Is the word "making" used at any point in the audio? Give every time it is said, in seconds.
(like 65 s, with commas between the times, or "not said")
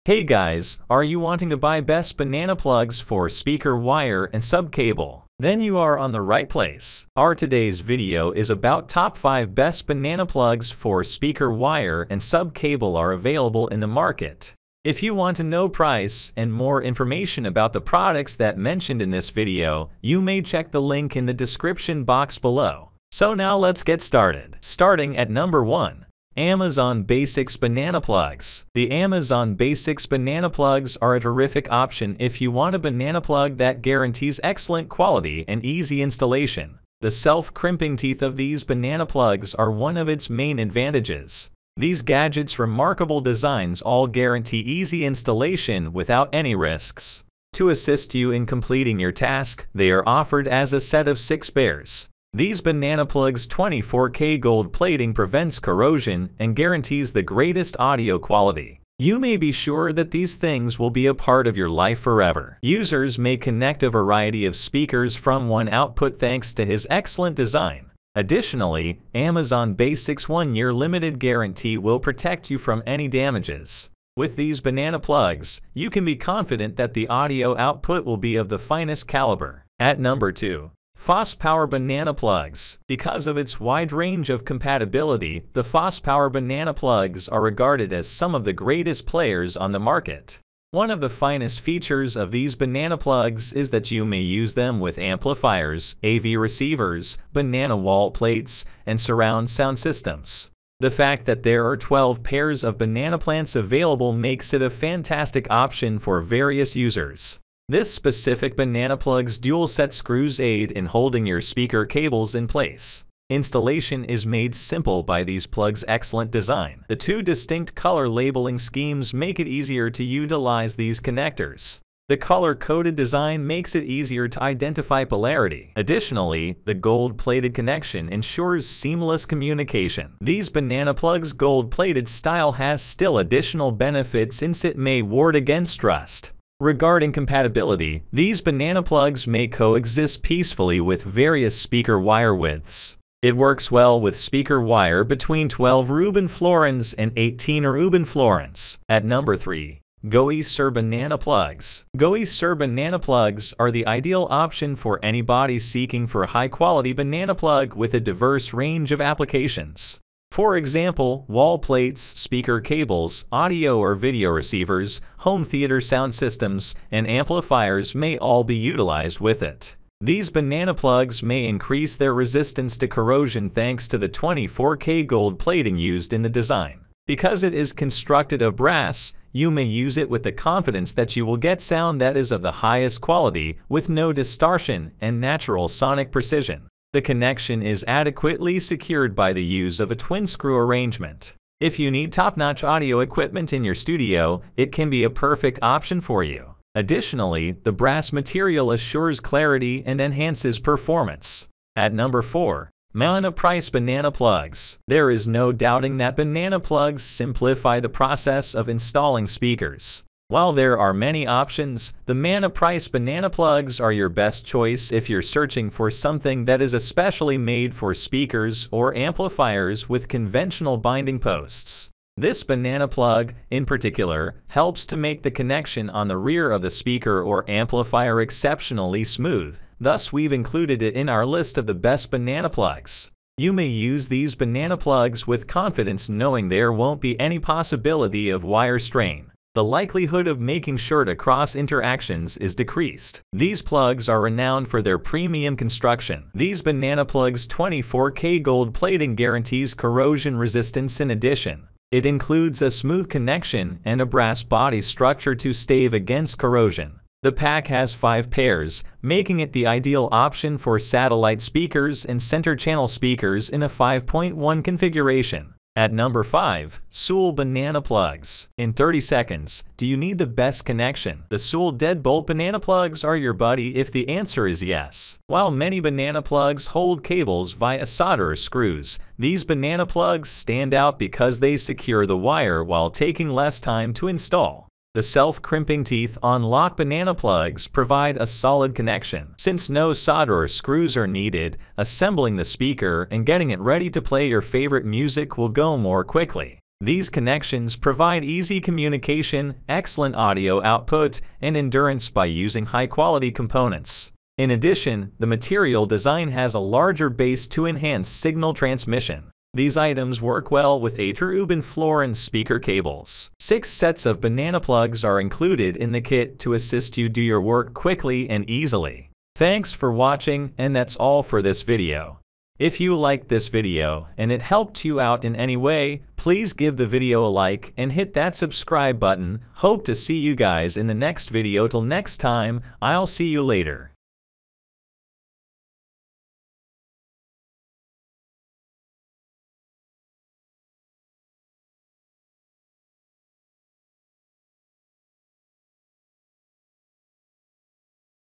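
240 s, 259 s.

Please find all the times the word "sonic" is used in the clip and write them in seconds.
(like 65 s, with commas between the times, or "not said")
185 s.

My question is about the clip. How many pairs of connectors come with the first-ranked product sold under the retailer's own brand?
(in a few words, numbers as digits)
6.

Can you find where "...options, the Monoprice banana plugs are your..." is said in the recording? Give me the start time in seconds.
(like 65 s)
211 s.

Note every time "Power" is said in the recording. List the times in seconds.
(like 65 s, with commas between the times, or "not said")
81 s, 86 s.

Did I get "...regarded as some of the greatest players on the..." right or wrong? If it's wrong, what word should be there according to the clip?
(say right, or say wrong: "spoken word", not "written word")
right.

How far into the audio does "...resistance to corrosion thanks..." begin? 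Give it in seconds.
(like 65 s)
172 s.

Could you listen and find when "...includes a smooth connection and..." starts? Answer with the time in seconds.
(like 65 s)
252 s.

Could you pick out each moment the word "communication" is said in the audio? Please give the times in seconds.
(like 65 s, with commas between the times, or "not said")
129 s, 298 s.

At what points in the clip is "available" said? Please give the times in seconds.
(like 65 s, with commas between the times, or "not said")
13 s, 103 s.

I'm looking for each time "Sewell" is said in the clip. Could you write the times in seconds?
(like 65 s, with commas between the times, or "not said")
266 s, 271 s.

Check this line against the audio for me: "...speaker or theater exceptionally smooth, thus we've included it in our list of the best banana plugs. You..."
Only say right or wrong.
wrong.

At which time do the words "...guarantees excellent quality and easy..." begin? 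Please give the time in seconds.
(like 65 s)
33 s.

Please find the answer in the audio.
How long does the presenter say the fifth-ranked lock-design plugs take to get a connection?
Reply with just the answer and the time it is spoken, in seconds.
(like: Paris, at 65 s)
30 seconds, at 268 s.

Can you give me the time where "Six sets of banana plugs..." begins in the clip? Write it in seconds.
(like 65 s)
313 s.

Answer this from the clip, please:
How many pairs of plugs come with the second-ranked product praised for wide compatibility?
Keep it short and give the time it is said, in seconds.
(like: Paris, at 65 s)
12, at 101 s.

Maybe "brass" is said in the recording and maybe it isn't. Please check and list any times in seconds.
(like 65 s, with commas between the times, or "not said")
178 s, 197 s, 254 s.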